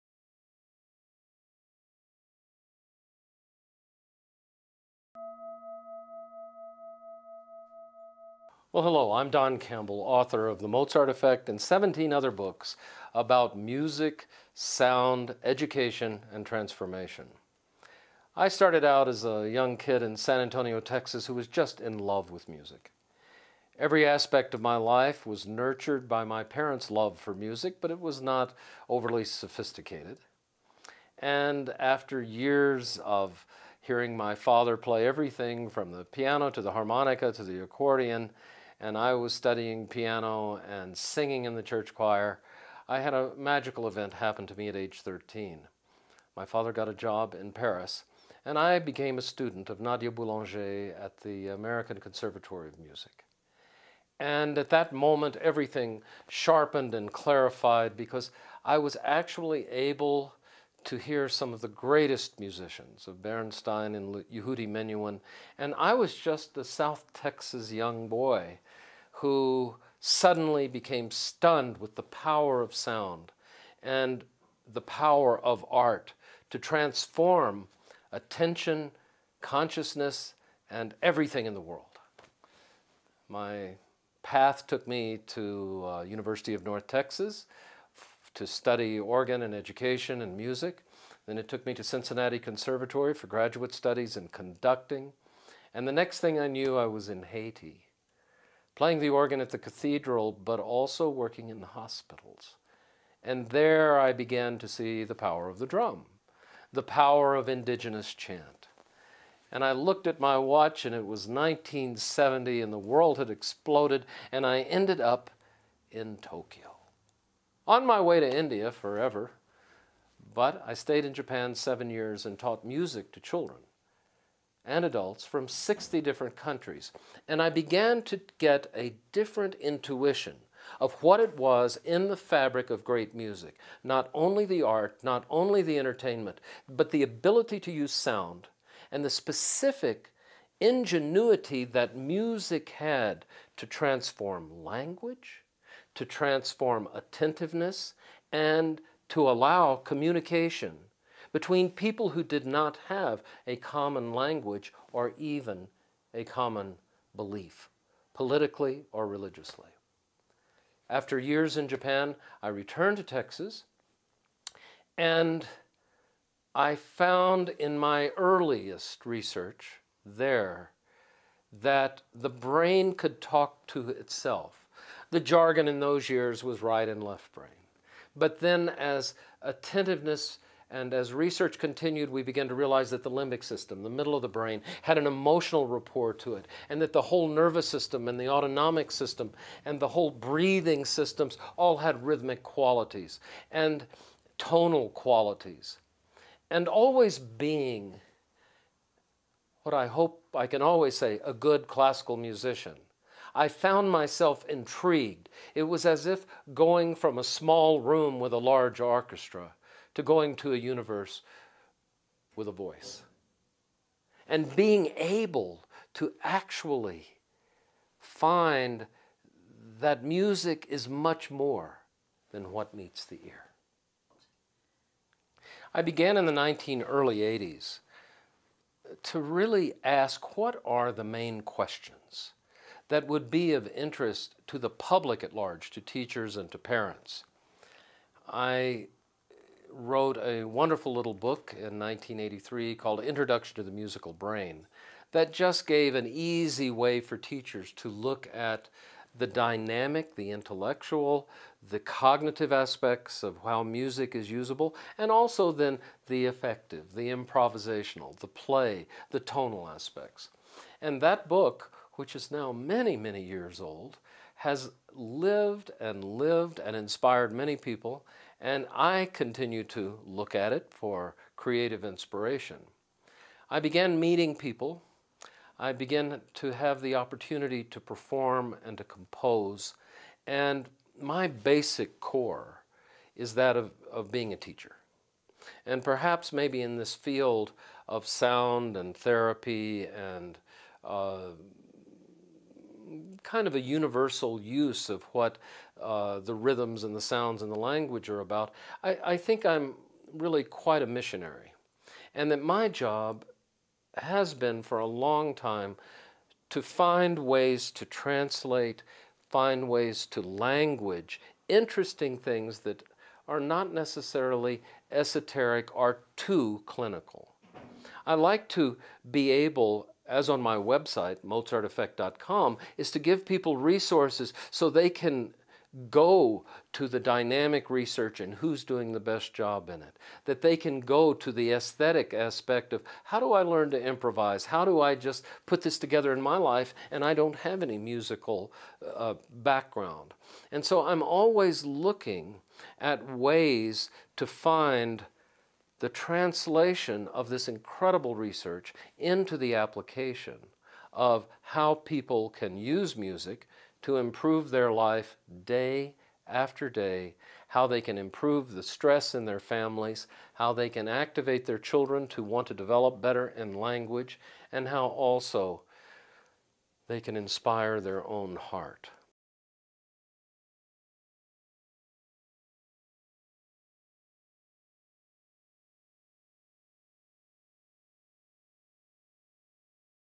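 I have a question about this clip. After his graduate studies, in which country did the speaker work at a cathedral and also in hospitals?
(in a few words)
Haiti.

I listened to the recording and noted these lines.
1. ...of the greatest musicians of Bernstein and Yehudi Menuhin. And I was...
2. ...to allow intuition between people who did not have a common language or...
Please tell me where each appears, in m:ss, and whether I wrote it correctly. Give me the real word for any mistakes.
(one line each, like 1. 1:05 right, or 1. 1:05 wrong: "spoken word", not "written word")
1. 1:01 right
2. 2:29 wrong: "communication", not "intuition".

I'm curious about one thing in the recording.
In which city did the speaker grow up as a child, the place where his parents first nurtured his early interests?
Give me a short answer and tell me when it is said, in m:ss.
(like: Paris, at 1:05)
San Antonio, at 0:20.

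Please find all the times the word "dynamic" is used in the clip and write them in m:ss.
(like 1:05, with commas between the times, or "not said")
4:09, 5:26.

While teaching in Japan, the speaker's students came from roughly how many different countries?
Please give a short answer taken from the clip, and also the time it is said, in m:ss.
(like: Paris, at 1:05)
60, at 2:05.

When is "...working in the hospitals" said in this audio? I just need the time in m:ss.
1:41.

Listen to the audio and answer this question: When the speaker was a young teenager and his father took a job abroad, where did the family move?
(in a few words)
Paris.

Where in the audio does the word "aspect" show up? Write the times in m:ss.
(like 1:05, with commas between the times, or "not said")
0:24, 4:12, 4:19, 5:32.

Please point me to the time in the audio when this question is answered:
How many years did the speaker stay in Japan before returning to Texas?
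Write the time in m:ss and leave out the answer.
2:01.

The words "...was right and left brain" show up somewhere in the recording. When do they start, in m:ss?
2:56.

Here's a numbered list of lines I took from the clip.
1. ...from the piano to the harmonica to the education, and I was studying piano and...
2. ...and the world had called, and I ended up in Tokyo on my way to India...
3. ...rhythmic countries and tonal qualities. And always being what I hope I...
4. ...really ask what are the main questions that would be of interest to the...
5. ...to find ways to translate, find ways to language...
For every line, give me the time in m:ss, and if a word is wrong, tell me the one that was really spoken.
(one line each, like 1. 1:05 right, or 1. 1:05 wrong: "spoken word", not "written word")
1. 0:35 wrong: "accordion", not "education"
2. 1:52 wrong: "exploded", not "called"
3. 3:12 wrong: "qualities", not "countries"
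4. 3:49 right
5. 5:06 right.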